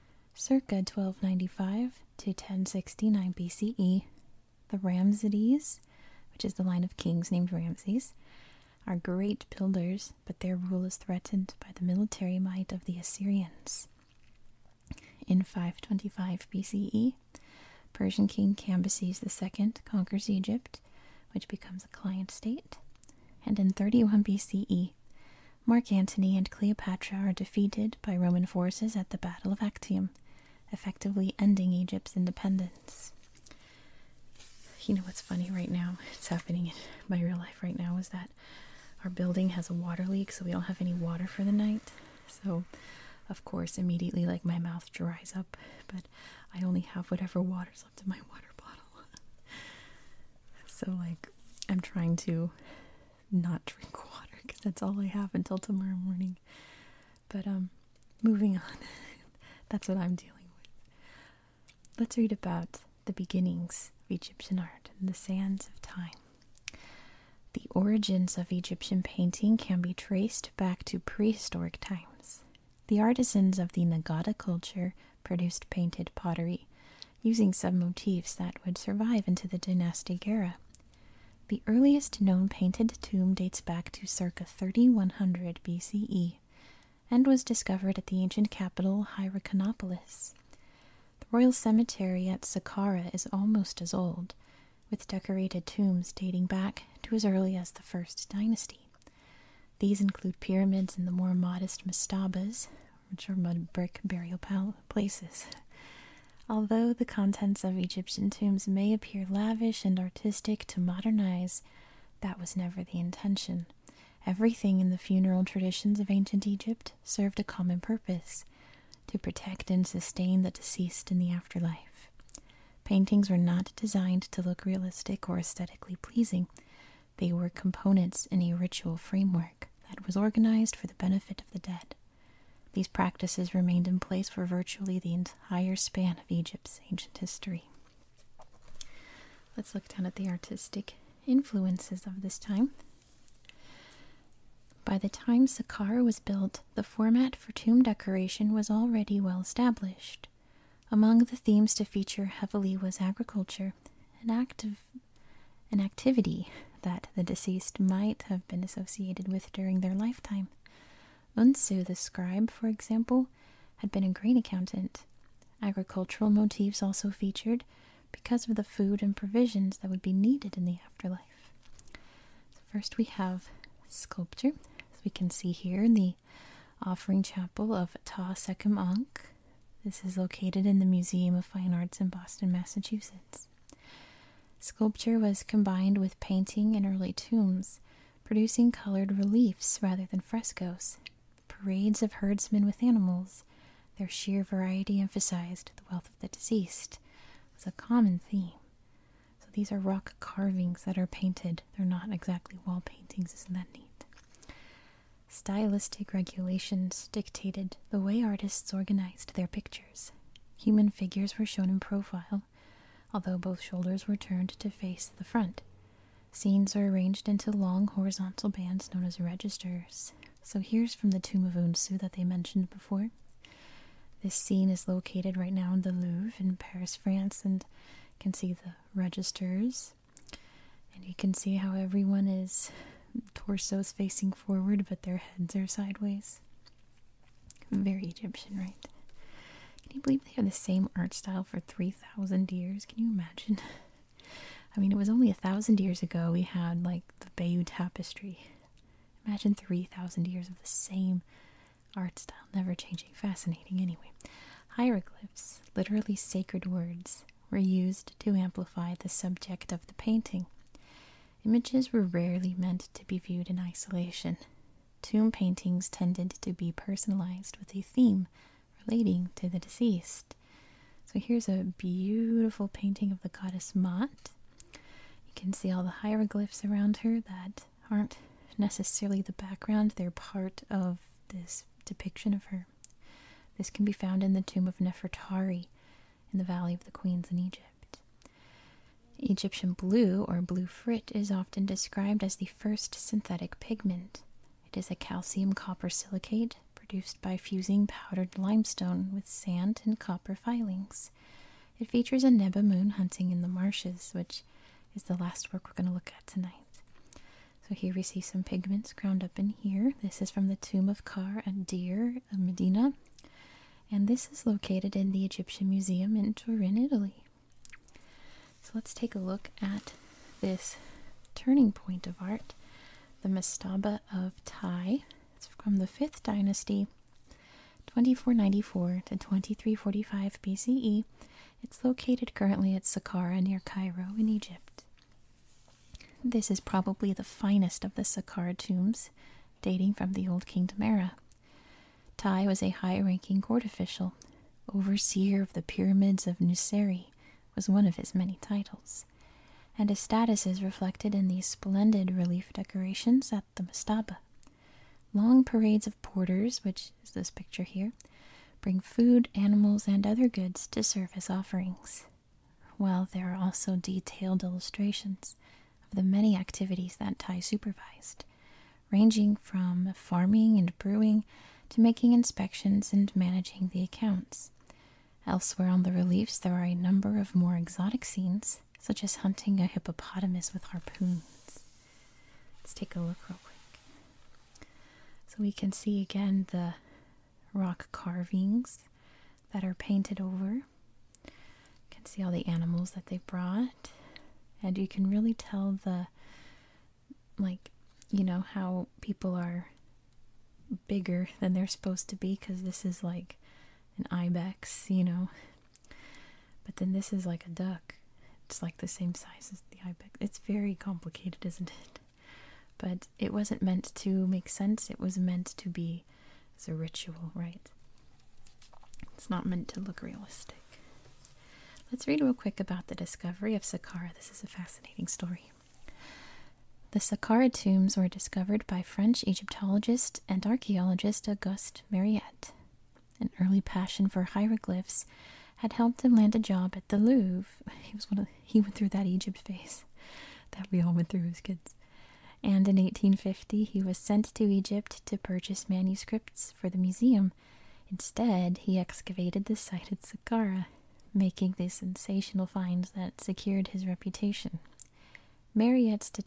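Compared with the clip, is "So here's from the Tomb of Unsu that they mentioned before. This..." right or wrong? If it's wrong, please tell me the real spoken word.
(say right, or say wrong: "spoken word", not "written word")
right.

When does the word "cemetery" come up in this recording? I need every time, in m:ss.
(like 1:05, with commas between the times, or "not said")
1:31.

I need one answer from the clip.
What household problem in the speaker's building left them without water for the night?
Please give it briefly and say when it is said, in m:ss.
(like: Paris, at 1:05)
A water leak, at 0:39.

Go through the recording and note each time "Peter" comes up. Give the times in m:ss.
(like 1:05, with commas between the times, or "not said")
not said.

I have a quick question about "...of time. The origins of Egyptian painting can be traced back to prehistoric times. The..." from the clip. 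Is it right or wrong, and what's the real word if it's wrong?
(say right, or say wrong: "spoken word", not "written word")
right.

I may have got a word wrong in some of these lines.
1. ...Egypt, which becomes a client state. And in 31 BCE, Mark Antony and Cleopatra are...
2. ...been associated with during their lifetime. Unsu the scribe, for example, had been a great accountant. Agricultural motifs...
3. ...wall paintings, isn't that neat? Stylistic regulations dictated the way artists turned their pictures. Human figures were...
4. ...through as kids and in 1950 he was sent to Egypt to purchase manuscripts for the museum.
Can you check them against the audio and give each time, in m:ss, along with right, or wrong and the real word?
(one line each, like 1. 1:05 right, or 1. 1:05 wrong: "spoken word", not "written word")
1. 0:20 right
2. 2:38 right
3. 3:22 wrong: "organized", not "turned"
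4. 7:21 wrong: "1850", not "1950".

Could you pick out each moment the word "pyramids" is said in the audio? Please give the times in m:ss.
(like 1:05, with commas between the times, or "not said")
1:40, 5:45.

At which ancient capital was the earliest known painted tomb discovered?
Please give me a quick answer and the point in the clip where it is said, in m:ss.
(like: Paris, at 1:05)
Hierakonopolis, at 1:29.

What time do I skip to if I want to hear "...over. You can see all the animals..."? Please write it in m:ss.
6:30.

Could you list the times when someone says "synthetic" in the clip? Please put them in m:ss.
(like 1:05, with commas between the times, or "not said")
4:52.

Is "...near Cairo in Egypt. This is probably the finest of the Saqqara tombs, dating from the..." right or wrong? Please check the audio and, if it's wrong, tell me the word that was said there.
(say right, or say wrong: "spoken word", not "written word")
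right.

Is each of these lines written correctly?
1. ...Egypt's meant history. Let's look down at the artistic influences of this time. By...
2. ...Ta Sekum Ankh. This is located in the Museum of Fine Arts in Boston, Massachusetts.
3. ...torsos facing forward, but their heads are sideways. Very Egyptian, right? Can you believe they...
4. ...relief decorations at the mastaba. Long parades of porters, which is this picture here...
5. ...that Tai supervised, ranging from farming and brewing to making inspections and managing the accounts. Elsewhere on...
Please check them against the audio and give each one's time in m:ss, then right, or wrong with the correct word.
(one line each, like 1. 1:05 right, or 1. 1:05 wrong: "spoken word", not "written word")
1. 2:16 wrong: "ancient", not "meant"
2. 2:58 right
3. 3:53 right
4. 5:52 right
5. 6:06 right.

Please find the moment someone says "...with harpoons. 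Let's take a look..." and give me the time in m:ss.
6:20.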